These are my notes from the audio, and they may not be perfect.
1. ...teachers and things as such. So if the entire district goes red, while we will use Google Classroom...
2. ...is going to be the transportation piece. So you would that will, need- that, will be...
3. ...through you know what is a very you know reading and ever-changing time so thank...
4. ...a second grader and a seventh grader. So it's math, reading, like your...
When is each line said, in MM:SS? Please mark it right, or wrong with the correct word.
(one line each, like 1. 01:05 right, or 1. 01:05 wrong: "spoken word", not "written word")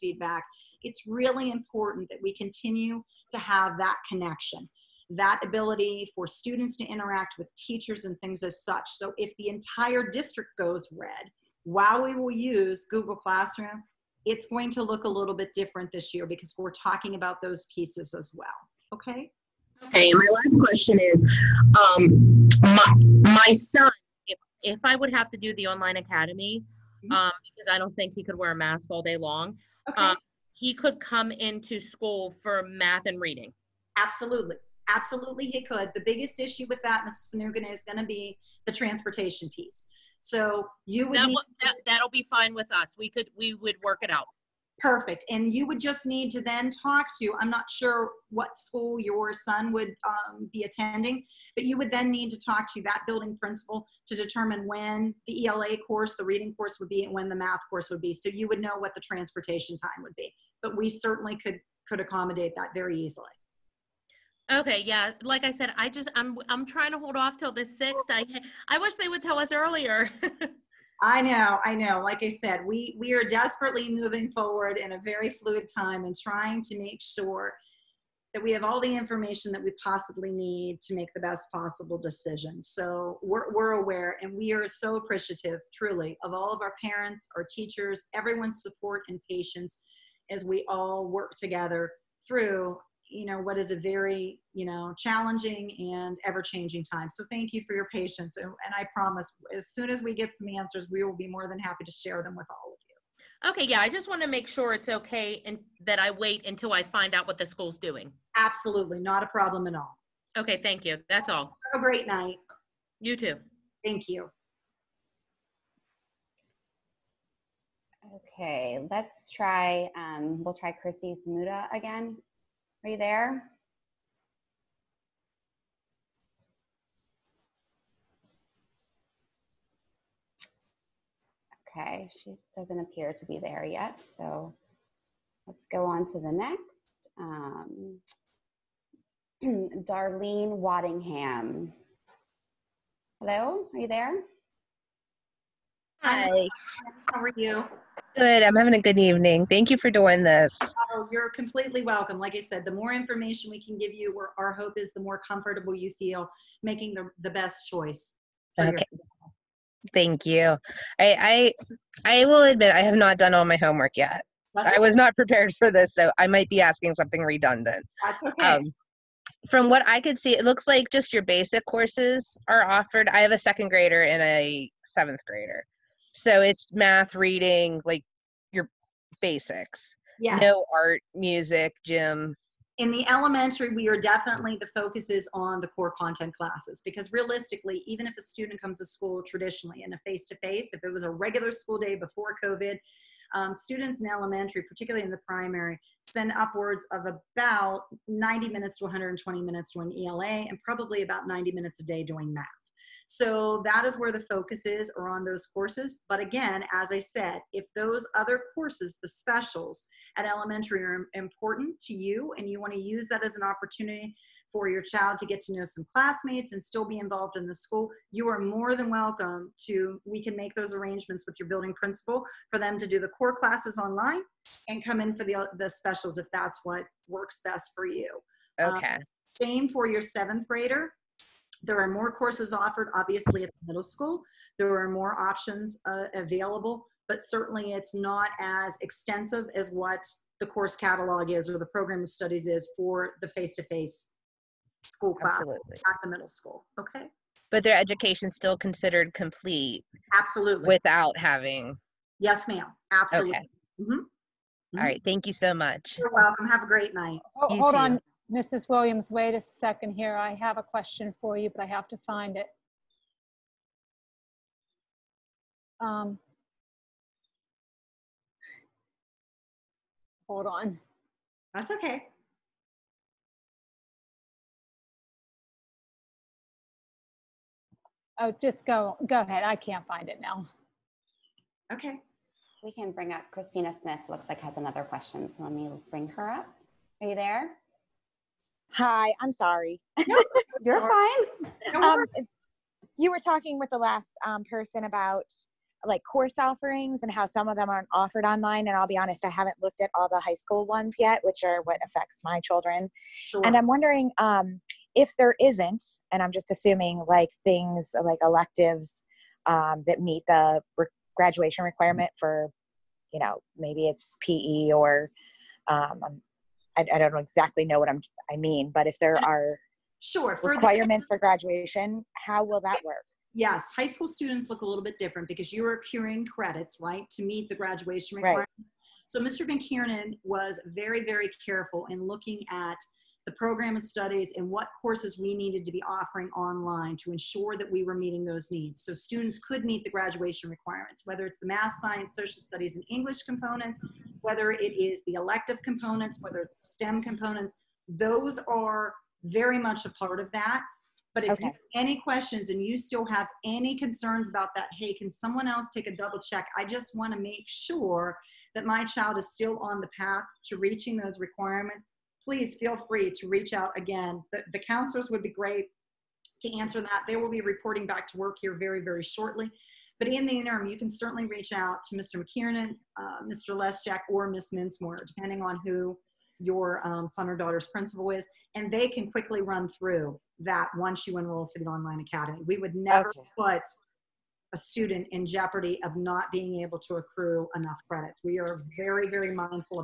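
1. 00:07 right
2. 00:37 right
3. 01:32 wrong: "challenging", not "reading"
4. 02:53 right.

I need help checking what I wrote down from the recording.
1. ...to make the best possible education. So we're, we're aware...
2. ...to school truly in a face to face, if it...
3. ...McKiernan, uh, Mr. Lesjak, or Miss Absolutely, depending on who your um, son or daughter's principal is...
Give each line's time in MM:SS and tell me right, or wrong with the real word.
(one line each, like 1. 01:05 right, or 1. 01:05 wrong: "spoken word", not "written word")
1. 01:20 wrong: "decision", not "education"
2. 03:08 wrong: "traditionally", not "truly"
3. 06:12 wrong: "Minsmore", not "Absolutely".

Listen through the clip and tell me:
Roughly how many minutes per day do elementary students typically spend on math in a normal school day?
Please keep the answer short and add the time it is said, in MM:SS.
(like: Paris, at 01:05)
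90 minutes, at 03:21.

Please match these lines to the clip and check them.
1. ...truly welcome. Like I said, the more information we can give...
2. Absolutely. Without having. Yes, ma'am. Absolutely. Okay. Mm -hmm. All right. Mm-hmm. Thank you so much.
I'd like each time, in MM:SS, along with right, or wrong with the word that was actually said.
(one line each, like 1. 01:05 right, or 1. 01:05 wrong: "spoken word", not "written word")
1. 02:31 wrong: "completely", not "truly"
2. 04:10 right.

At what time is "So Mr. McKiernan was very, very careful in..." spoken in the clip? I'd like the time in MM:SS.
05:29.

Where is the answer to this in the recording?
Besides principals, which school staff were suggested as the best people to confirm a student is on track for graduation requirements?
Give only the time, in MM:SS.
06:04.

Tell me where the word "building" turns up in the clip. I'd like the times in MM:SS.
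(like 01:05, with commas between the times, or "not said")
00:53, 03:41.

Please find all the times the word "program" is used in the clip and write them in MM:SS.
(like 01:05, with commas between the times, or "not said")
04:01, 05:33.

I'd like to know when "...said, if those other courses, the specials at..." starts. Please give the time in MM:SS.
03:26.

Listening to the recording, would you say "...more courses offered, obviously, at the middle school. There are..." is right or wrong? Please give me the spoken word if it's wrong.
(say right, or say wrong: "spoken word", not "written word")
right.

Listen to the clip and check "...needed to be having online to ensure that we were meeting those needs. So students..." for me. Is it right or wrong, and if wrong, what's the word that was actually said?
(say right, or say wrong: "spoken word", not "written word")
wrong: "offering", not "having".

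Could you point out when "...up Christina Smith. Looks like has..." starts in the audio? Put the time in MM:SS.
04:43.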